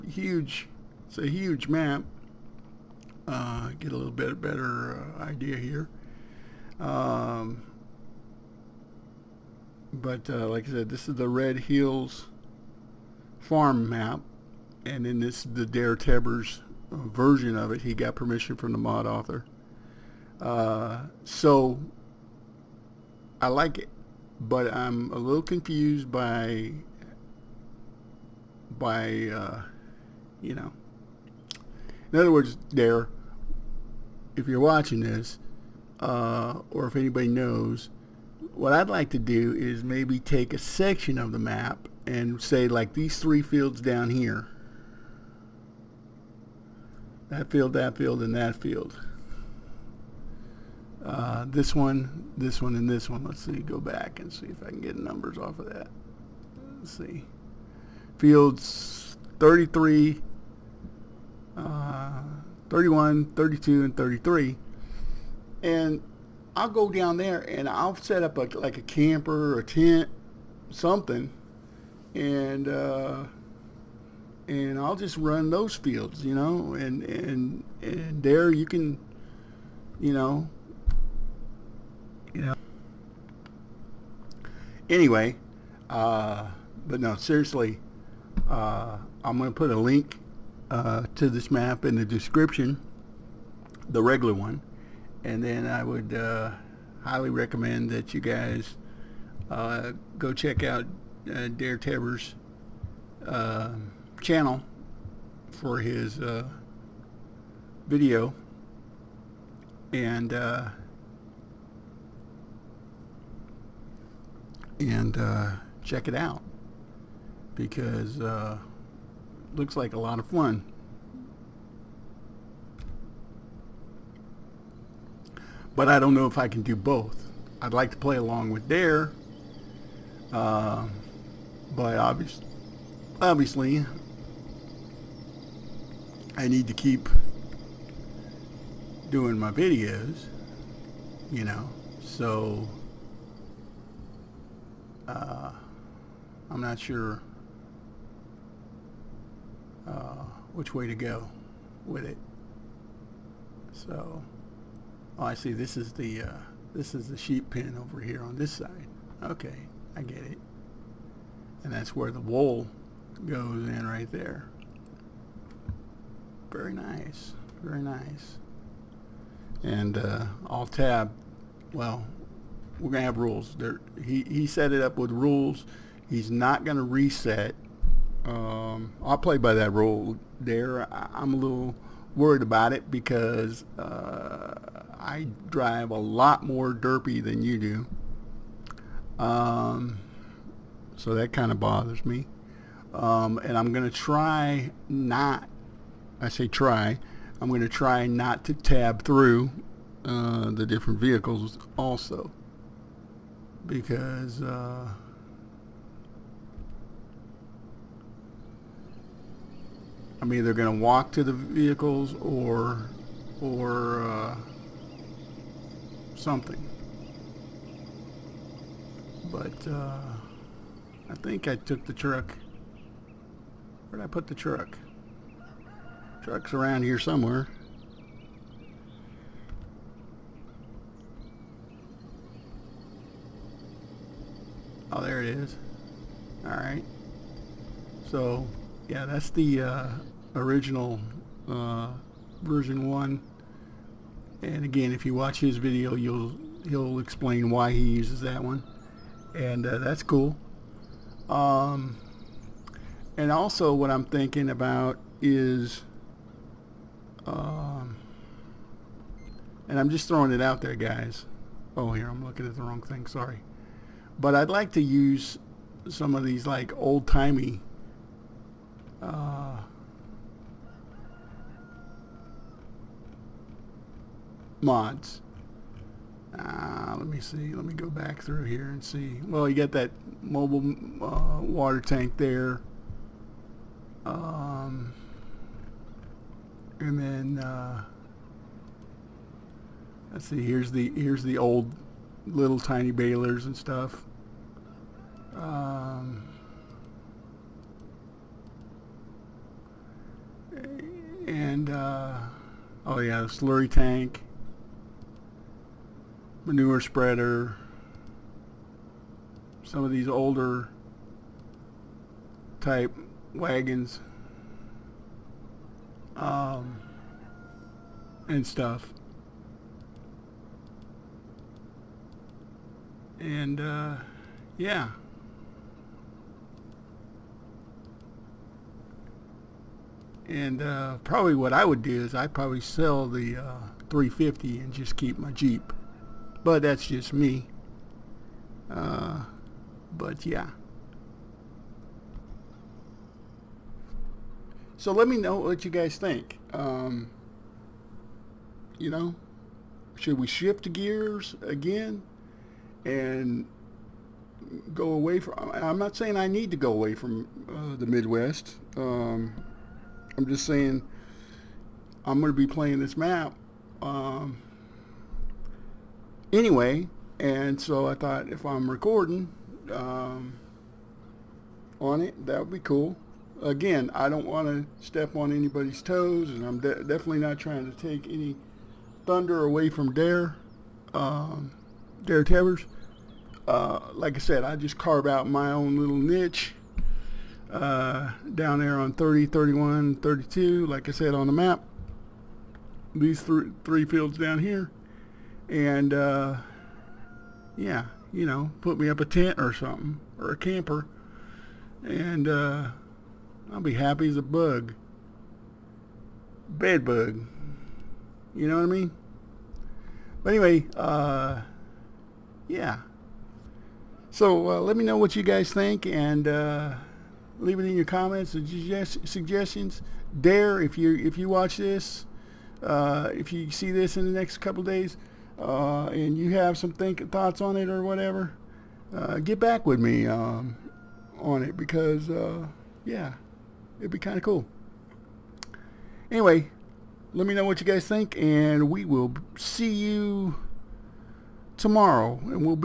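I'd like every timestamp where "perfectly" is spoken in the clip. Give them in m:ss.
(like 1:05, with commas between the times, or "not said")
not said.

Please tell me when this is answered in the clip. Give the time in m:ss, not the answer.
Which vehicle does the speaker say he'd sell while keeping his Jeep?
5:33.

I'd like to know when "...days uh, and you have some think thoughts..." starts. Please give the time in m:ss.
7:04.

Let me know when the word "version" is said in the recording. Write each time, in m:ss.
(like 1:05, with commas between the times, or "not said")
0:16, 4:02.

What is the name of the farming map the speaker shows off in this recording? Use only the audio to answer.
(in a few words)
Red Hills.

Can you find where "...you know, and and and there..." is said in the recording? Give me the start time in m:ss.
1:16.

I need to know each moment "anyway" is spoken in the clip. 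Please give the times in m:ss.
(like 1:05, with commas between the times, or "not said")
1:24, 6:06, 6:50, 7:16.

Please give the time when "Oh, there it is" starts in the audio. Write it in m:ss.
3:54.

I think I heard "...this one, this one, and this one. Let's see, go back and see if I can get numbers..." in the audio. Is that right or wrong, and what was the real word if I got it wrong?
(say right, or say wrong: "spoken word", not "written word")
right.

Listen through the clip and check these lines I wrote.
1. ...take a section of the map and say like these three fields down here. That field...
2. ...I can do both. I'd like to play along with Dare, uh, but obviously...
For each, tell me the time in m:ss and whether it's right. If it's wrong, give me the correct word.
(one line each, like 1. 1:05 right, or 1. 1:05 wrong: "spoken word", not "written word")
1. 0:40 right
2. 2:06 right.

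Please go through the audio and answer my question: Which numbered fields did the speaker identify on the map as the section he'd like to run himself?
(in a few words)
31, 32, and 33.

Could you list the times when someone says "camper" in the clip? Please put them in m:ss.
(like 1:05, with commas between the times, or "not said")
1:08, 6:40.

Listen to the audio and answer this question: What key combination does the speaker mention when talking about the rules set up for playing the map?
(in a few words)
Alt Tab.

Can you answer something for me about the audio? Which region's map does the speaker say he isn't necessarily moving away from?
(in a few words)
the Midwest.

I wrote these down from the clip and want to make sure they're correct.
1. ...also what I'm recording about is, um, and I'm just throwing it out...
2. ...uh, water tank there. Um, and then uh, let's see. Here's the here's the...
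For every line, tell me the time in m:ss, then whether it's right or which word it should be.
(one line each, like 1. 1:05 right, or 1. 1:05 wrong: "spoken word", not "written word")
1. 4:13 wrong: "thinking", not "recording"
2. 4:41 right.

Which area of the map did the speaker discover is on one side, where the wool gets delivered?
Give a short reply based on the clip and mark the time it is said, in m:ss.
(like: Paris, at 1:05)
sheep pen, at 2:37.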